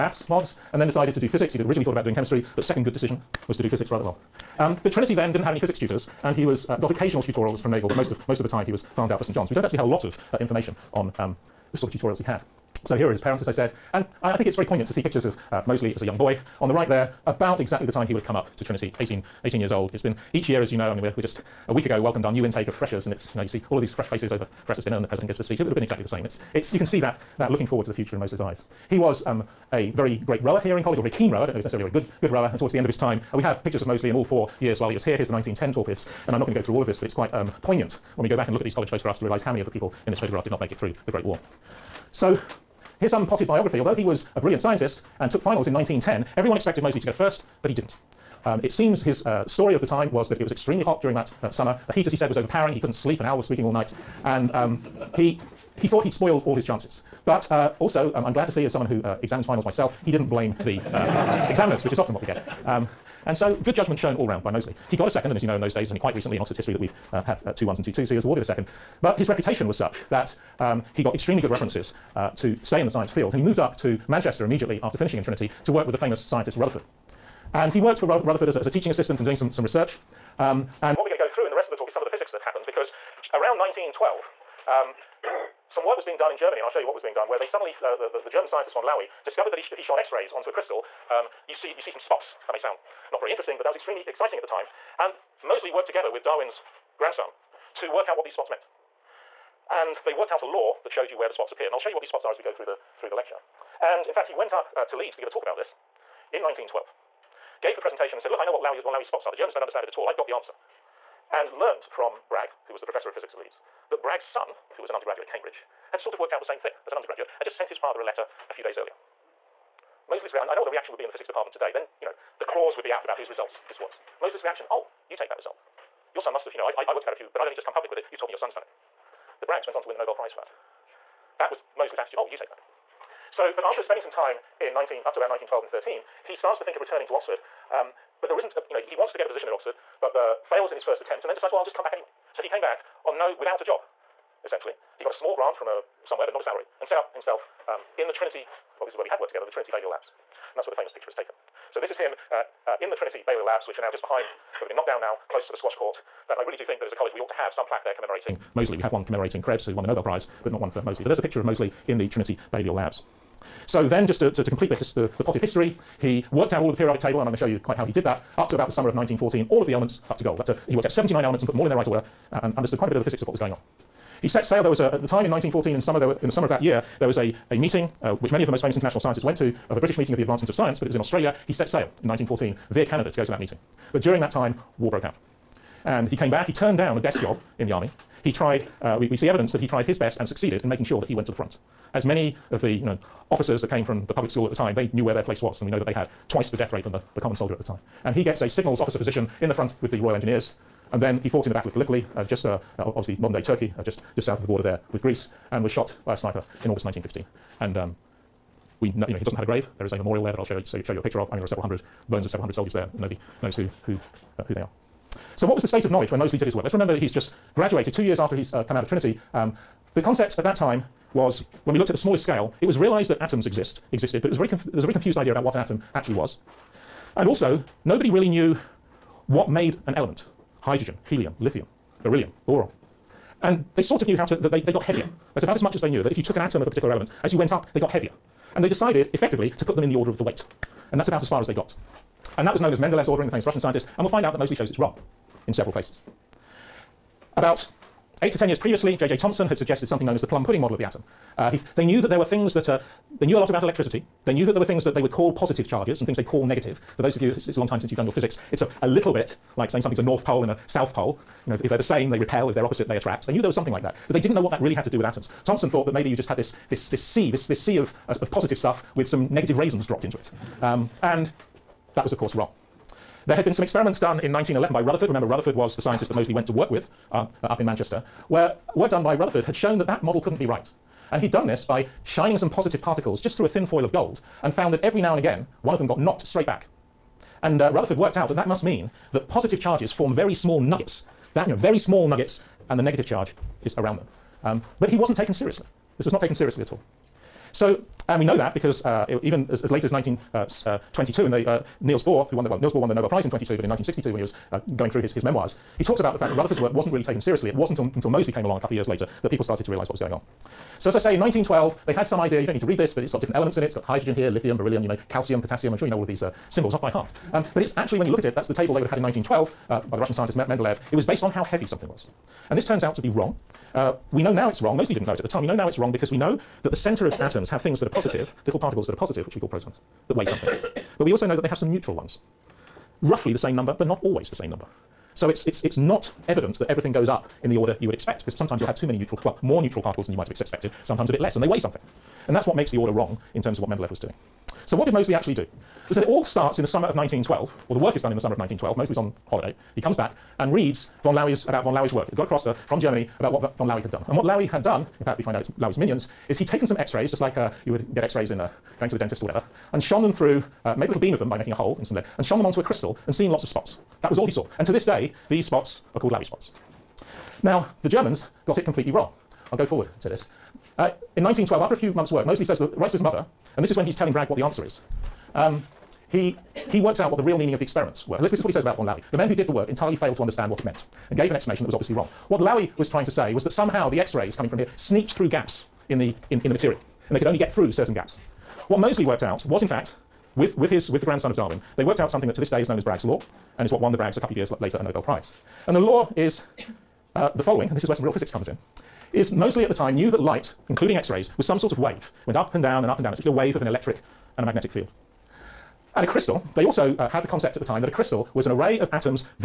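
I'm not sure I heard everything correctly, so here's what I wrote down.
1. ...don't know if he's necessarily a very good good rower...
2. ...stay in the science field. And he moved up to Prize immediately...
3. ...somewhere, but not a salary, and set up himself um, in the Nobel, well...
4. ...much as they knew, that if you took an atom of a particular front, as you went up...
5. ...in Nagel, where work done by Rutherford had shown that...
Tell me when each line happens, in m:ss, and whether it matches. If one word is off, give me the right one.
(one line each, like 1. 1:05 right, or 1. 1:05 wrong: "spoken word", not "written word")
1. 0:31 right
2. 1:12 wrong: "Manchester", not "Prize"
3. 2:26 wrong: "Trinity", not "Nobel"
4. 3:55 wrong: "element", not "front"
5. 4:37 wrong: "Manchester", not "Nagel".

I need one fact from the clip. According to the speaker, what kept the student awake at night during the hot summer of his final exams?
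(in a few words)
An owl.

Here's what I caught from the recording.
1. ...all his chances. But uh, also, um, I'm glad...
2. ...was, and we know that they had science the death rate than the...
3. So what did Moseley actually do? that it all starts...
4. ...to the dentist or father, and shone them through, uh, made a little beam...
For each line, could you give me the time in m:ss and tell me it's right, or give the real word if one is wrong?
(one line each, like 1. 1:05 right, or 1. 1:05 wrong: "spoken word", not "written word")
1. 0:56 right
2. 3:15 wrong: "twice", not "science"
3. 5:44 right
4. 5:58 wrong: "whatever", not "father".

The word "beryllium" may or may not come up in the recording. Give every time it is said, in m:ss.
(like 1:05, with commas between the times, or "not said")
3:52, 5:14.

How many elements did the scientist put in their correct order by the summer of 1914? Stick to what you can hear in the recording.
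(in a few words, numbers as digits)
79.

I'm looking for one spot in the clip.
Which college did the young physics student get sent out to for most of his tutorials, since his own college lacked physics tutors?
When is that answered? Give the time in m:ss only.
0:09.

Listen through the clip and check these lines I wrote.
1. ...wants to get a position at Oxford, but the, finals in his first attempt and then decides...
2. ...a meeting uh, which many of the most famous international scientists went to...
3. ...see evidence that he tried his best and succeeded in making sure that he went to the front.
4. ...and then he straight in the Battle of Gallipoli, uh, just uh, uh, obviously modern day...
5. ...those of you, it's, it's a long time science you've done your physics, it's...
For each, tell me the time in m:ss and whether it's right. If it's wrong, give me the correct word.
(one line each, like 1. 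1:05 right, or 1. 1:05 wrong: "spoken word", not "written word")
1. 2:18 wrong: "fails", not "finals"
2. 2:57 right
3. 3:09 right
4. 3:20 wrong: "fought", not "straight"
5. 4:17 wrong: "since", not "science".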